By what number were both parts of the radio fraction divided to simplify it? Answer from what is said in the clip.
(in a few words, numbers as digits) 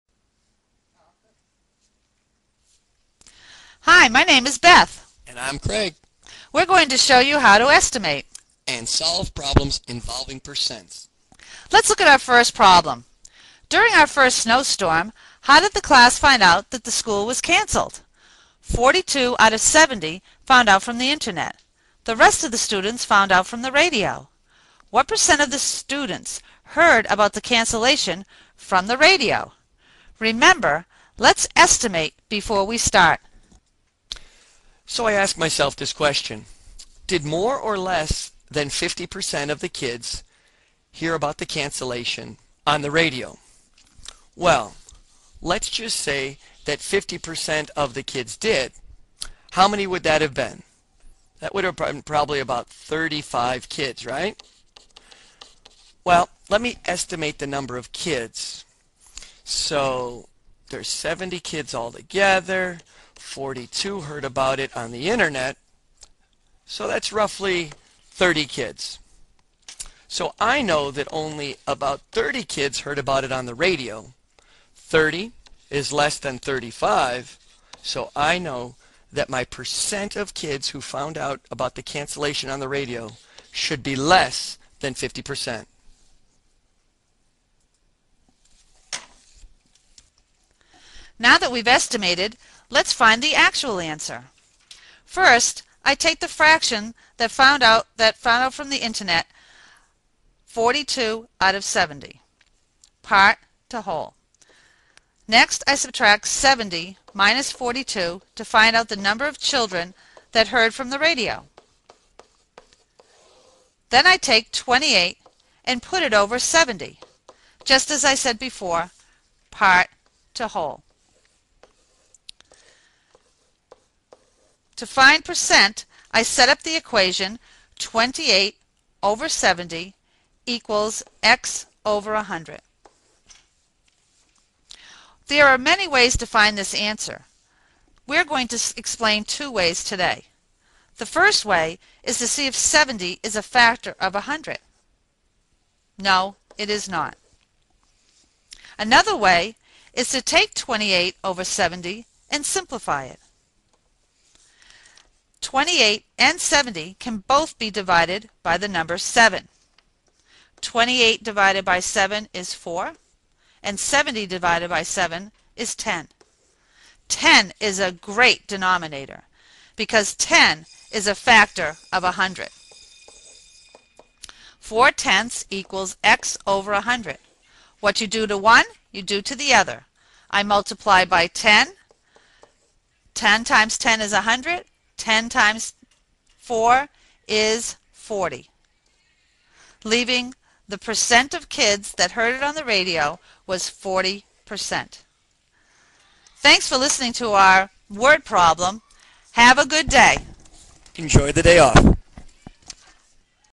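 7.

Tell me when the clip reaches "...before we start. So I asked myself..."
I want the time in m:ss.
0:32.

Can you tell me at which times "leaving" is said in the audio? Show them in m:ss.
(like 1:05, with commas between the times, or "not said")
3:09.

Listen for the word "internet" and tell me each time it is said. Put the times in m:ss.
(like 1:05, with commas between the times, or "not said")
0:21, 1:05, 1:38.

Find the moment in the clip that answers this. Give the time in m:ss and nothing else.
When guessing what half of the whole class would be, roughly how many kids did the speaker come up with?
0:52.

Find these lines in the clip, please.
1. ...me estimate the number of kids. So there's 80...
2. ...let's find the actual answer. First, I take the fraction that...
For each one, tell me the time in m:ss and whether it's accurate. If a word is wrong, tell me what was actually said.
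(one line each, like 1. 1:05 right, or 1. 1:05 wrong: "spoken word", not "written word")
1. 0:56 wrong: "70", not "80"
2. 1:32 right.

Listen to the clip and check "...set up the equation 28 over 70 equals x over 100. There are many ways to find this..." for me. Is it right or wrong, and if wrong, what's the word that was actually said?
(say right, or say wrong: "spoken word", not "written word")
right.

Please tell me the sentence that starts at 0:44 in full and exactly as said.
Well, let's just say that 50% of the kids did.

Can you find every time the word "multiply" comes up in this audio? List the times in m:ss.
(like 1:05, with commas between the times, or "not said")
3:00.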